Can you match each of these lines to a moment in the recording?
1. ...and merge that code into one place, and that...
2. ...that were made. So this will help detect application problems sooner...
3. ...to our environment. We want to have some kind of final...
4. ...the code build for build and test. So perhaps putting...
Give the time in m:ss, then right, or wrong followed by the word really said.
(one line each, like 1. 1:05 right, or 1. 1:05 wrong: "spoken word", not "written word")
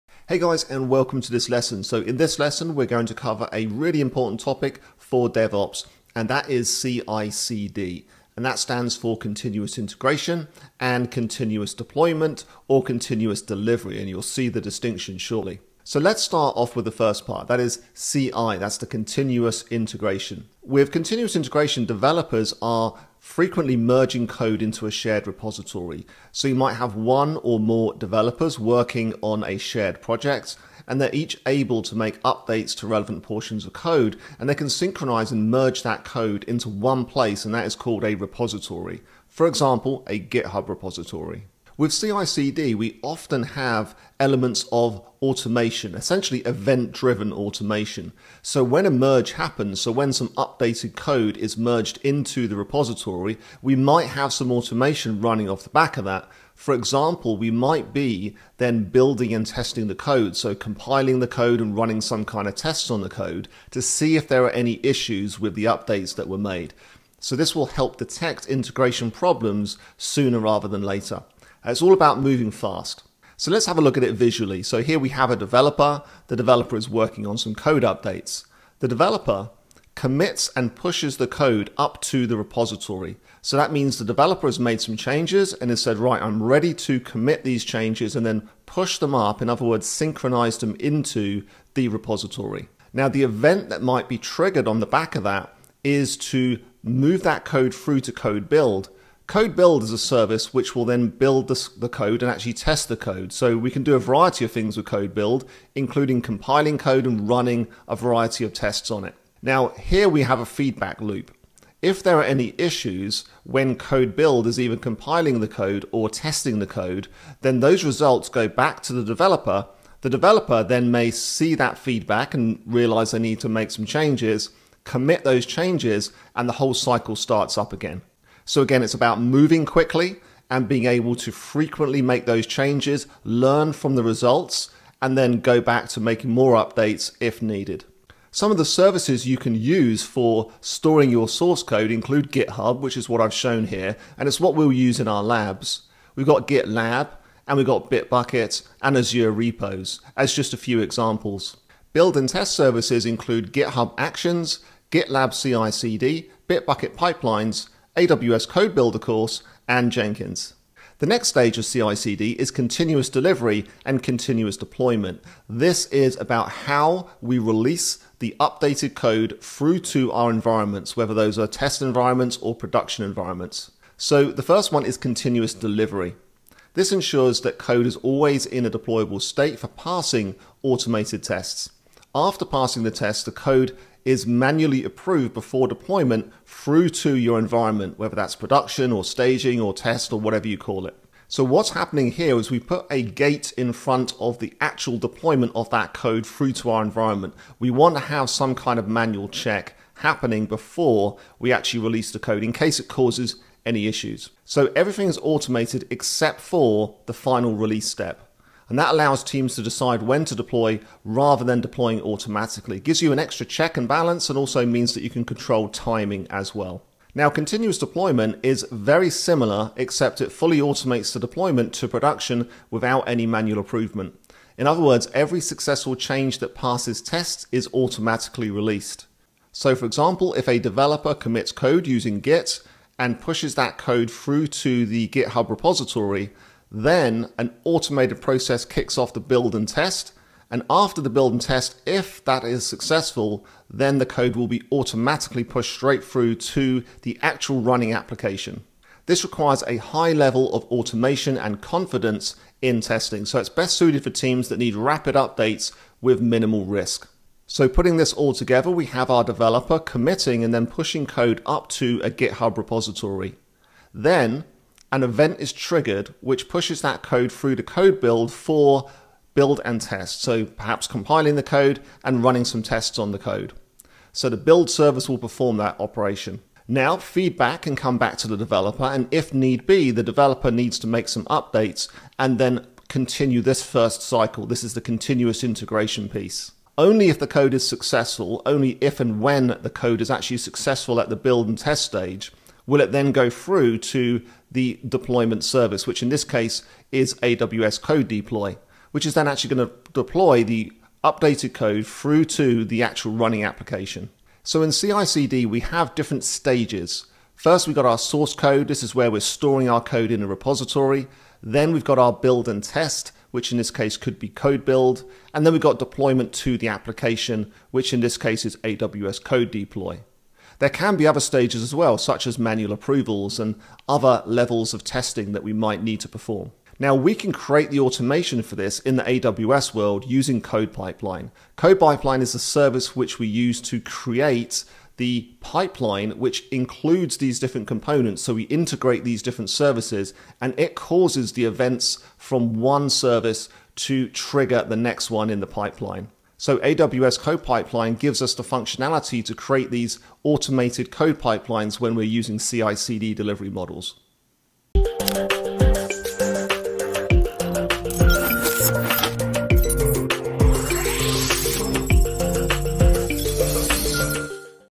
1. 0:35 right
2. 1:06 wrong: "integration", not "application"
3. 3:16 wrong: "manual", not "final"
4. 4:27 wrong: "compiling", not "putting".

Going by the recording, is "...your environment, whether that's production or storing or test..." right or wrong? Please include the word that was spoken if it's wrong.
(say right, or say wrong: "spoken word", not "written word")
wrong: "staging", not "storing".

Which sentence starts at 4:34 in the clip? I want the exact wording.
So the build service will perform that operation.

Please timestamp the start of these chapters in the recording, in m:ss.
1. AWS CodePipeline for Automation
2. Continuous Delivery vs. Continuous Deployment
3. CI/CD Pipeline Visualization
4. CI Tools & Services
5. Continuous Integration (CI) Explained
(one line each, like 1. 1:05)
1. 5:27
2. 2:41
3. 4:17
4. 2:18
5. 0:16.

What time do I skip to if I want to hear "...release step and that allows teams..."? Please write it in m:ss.
3:27.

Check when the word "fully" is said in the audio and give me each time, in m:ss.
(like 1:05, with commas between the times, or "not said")
3:40.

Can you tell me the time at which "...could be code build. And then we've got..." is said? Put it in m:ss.
5:13.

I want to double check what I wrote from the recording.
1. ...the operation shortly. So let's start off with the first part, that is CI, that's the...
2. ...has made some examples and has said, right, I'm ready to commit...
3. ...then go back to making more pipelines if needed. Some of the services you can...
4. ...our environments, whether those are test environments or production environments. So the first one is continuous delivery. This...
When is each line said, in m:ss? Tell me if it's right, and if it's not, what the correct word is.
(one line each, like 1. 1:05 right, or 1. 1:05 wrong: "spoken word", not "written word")
1. 0:14 wrong: "distinction", not "operation"
2. 1:24 wrong: "changes", not "examples"
3. 2:15 wrong: "updates", not "pipelines"
4. 2:50 right.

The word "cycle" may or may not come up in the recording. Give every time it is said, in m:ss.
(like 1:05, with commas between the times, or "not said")
2:06, 4:44.